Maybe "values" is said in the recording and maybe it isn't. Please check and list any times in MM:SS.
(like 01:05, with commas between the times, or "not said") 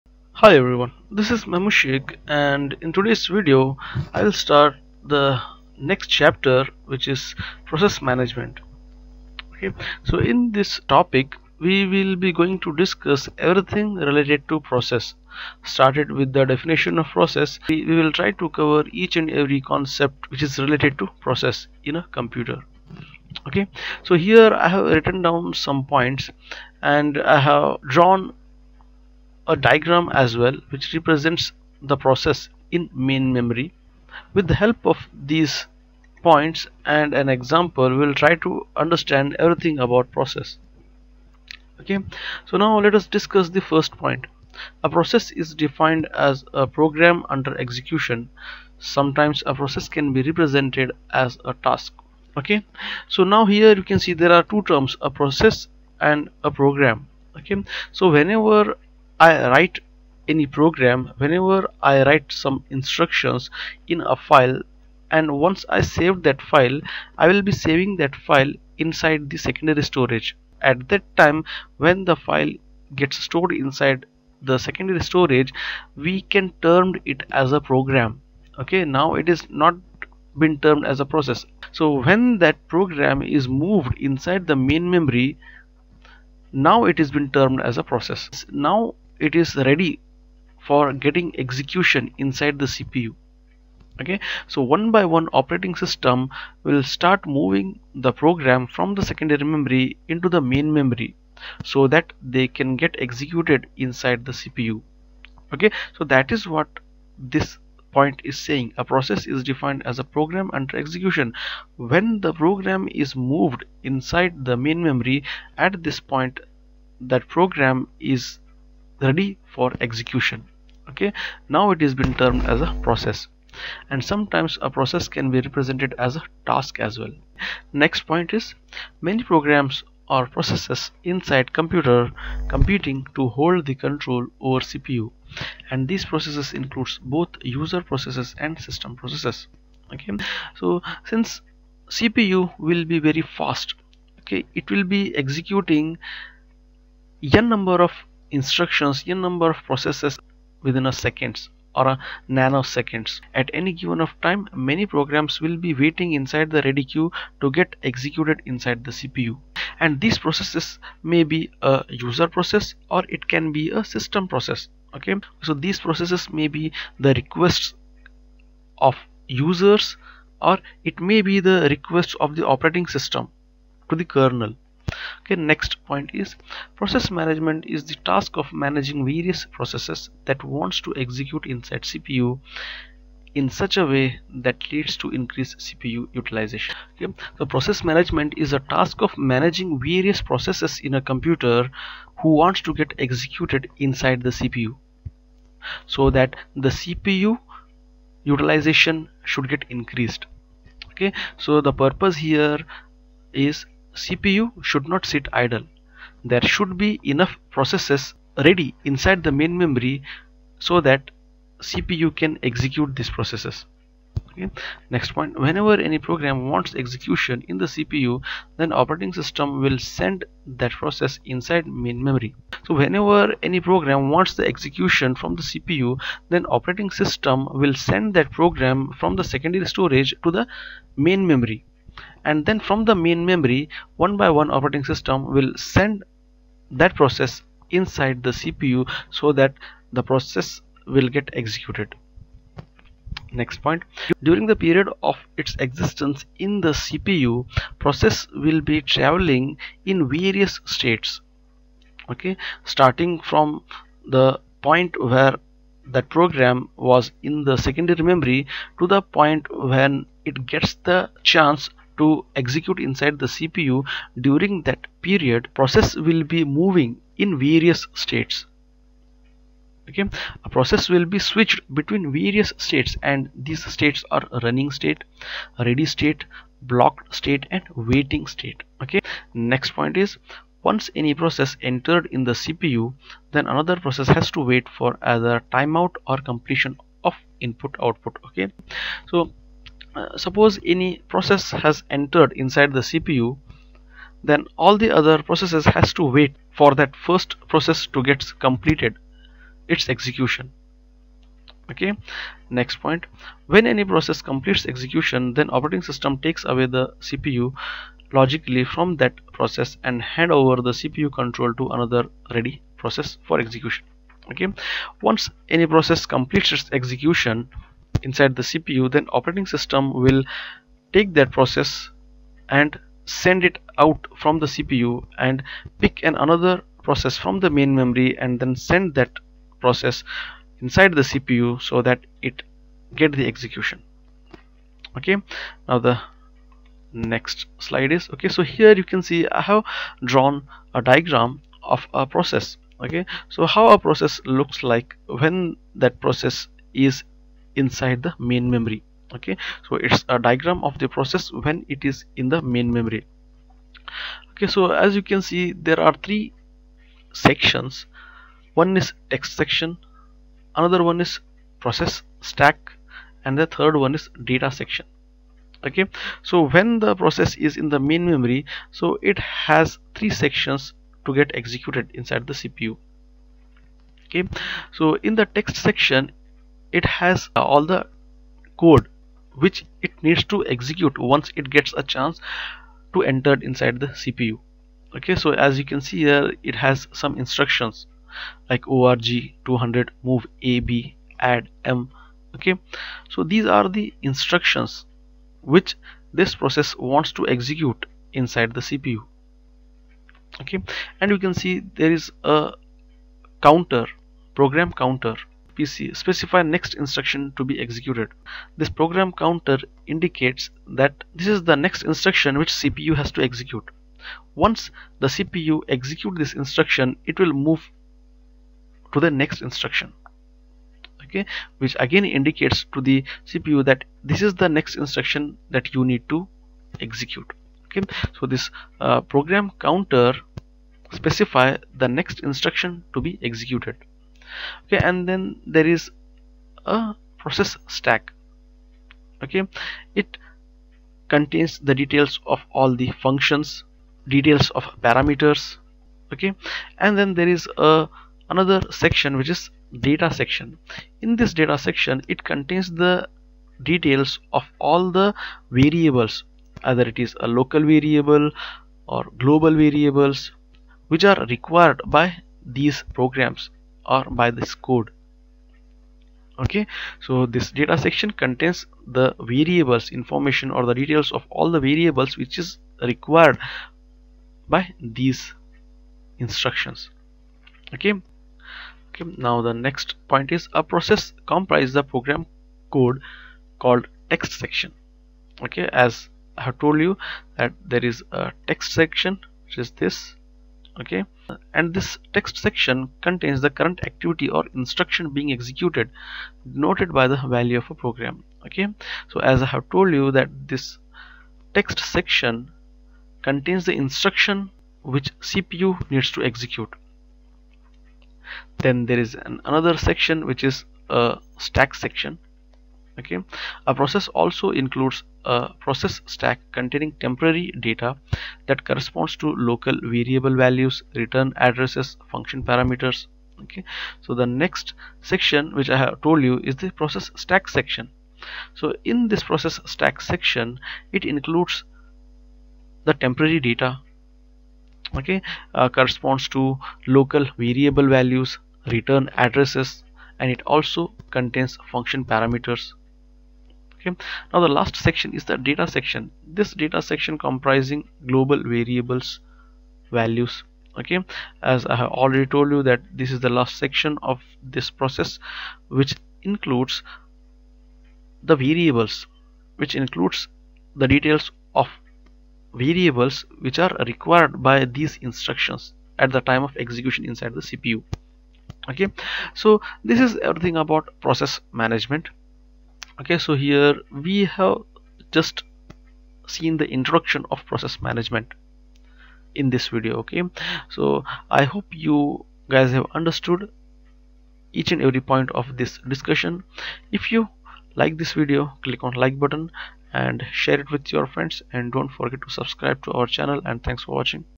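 08:17, 08:40, 08:57, 09:09.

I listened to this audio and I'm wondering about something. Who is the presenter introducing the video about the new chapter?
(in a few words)
Memushik.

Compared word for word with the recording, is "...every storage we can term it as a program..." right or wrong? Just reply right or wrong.
wrong.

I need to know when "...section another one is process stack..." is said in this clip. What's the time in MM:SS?
05:59.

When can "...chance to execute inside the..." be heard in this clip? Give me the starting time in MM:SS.
04:21.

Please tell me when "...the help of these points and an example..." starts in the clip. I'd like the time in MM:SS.
00:34.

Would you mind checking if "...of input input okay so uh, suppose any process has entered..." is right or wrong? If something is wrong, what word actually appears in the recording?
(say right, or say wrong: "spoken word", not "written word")
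wrong: "output", not "input".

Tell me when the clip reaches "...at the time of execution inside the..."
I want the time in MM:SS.
09:25.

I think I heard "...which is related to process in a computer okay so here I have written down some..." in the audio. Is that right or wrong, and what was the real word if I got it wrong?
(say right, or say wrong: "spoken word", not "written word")
right.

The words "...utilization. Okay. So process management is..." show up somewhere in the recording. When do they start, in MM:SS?
03:06.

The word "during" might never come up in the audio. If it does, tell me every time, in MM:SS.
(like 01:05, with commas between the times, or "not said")
04:04, 04:24.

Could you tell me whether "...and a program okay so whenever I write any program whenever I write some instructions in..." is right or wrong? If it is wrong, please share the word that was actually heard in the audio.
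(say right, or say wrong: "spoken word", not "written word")
right.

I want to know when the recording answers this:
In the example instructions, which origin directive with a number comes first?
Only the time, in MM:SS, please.
06:28.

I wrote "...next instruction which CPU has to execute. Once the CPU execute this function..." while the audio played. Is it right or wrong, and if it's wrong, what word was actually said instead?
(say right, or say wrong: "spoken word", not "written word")
wrong: "instruction", not "function".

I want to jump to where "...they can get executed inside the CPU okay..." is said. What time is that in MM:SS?
01:42.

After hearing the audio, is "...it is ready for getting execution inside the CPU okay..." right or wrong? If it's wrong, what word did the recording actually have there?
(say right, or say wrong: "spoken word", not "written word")
right.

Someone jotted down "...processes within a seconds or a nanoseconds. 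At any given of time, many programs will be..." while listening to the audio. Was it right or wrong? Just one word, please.
right.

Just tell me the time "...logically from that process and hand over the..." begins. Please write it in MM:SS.
05:08.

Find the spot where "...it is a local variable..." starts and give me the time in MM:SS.
07:36.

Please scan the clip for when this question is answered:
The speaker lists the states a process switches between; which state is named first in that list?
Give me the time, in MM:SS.
04:34.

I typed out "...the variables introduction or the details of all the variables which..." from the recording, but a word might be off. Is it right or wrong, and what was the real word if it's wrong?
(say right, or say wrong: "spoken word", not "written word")
wrong: "information", not "introduction".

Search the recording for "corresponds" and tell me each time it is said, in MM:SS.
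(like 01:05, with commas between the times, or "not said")
08:38, 08:55.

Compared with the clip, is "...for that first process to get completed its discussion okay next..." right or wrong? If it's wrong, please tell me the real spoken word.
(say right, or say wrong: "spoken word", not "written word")
wrong: "execution", not "discussion".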